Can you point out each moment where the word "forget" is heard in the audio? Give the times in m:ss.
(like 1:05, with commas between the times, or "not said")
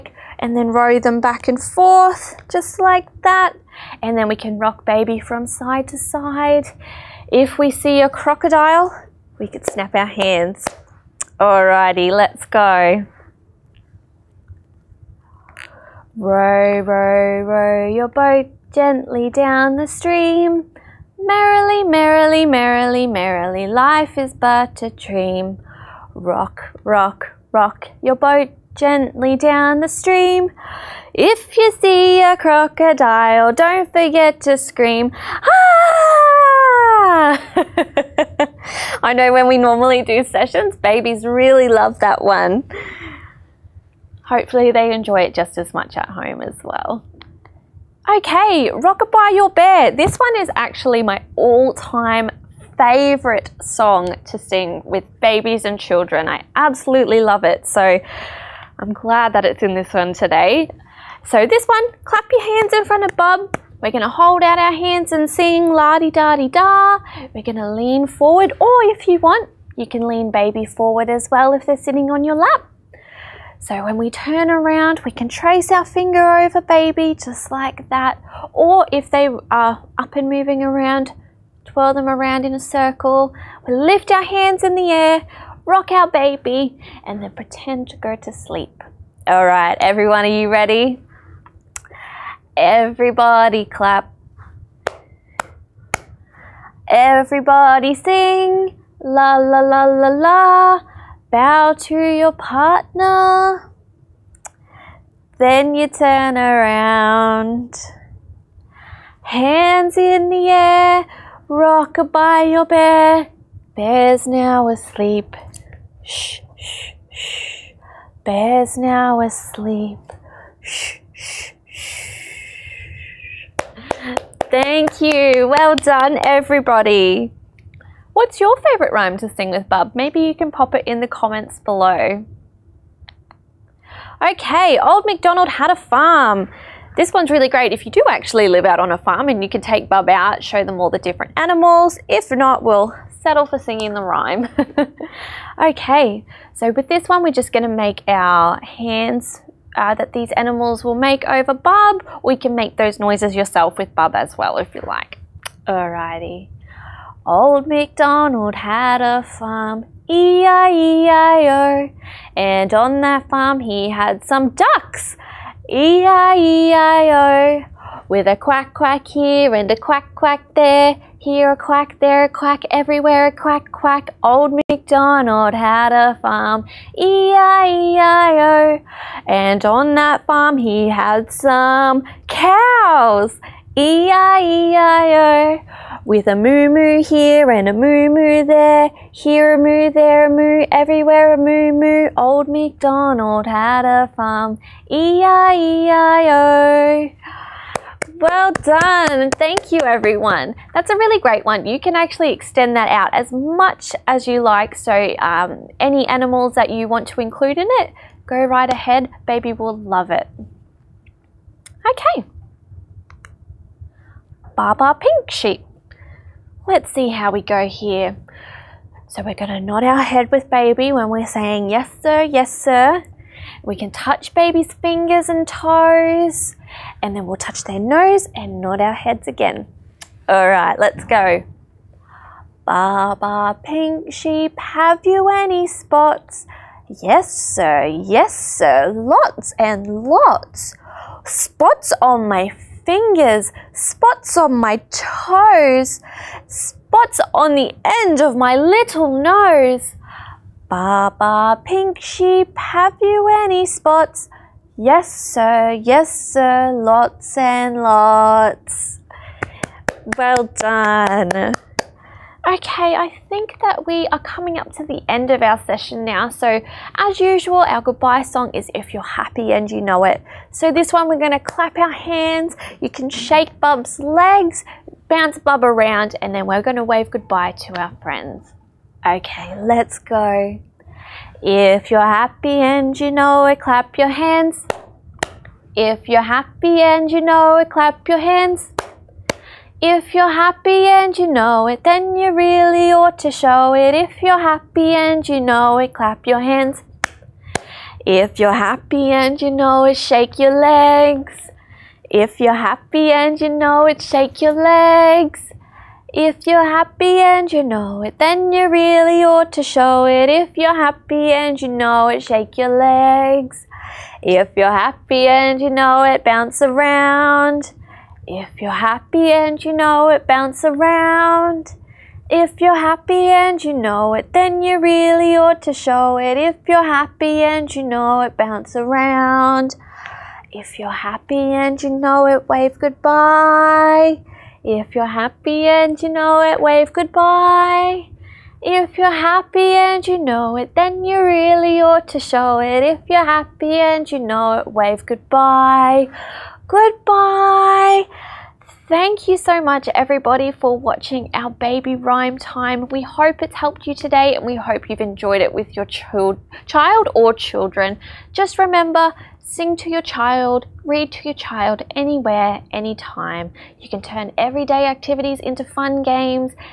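0:33.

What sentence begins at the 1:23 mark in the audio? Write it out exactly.
We lift our hands in the air, rock our baby, and then pretend to go to sleep.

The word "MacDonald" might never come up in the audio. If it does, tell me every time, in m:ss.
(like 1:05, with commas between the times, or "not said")
2:15, 2:37, 2:54, 3:12.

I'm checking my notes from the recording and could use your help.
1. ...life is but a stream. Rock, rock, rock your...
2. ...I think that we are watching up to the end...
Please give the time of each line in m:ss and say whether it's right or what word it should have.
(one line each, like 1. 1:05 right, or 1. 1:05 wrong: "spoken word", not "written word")
1. 0:23 wrong: "dream", not "stream"
2. 4:22 wrong: "coming", not "watching".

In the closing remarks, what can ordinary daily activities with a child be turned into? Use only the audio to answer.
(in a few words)
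fun games.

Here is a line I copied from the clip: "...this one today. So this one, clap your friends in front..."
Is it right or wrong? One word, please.
wrong.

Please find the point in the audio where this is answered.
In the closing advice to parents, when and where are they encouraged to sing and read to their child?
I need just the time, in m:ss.
6:01.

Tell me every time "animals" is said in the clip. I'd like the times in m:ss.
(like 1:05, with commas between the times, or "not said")
2:21, 2:30, 3:26.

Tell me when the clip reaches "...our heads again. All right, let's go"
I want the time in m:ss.
3:48.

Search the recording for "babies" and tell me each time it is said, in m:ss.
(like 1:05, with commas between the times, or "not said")
0:40, 0:55.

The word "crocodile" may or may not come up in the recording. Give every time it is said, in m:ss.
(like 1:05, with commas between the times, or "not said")
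0:08, 0:32.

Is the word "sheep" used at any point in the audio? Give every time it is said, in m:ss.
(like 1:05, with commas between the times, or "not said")
3:35, 3:54, 4:11.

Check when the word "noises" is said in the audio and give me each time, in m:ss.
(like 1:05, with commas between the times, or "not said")
2:32.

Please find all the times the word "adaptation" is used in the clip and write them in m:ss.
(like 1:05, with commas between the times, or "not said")
not said.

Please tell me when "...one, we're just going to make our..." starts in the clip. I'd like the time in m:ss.
2:27.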